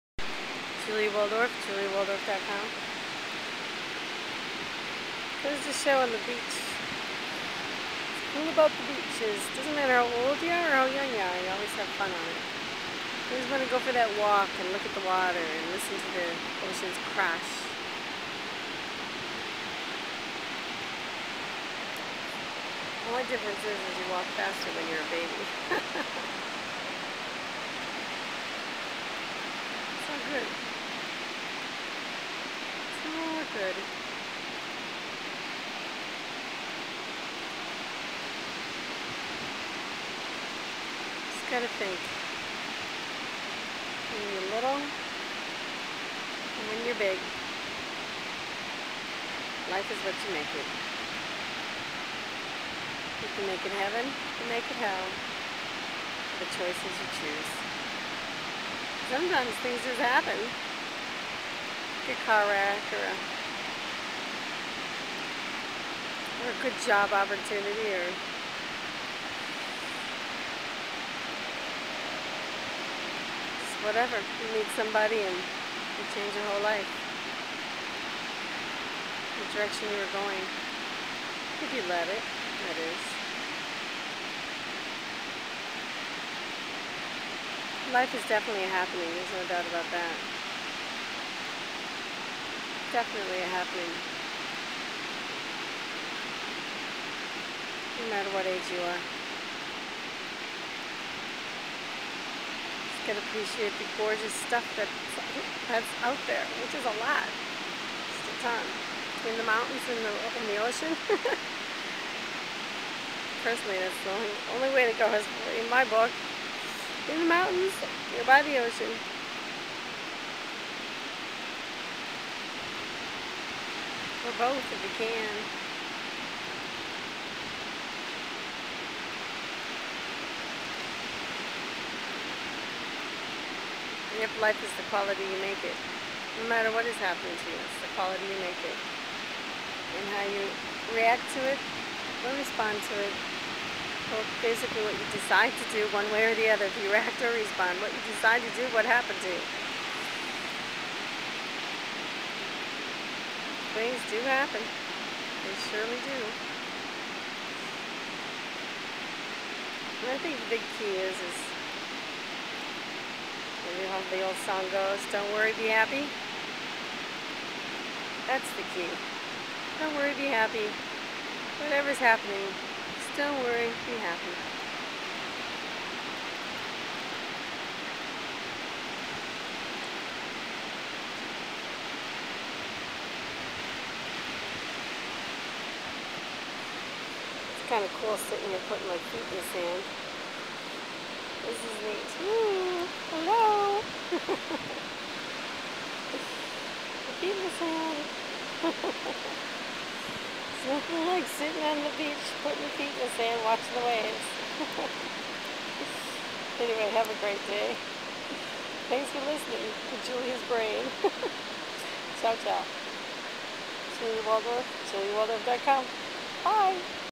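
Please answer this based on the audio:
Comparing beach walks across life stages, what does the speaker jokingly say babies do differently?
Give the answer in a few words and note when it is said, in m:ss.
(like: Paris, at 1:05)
walk faster, at 0:24.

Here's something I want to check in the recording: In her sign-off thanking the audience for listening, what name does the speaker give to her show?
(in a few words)
Julia's Brain.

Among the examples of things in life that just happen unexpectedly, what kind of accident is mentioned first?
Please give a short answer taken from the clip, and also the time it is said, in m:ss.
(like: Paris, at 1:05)
a car wreck, at 1:02.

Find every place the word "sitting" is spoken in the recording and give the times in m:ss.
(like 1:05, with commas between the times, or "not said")
3:08, 3:21.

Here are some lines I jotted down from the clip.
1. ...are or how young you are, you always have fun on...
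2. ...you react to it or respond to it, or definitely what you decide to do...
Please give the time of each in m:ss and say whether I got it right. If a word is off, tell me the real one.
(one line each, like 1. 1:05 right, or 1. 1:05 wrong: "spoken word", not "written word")
1. 0:10 right
2. 2:20 wrong: "basically", not "definitely".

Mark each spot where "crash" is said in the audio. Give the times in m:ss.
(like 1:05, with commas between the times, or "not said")
0:17.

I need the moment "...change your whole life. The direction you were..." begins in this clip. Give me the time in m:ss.
1:16.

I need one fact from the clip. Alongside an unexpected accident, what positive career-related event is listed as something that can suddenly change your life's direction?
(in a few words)
good job opportunity.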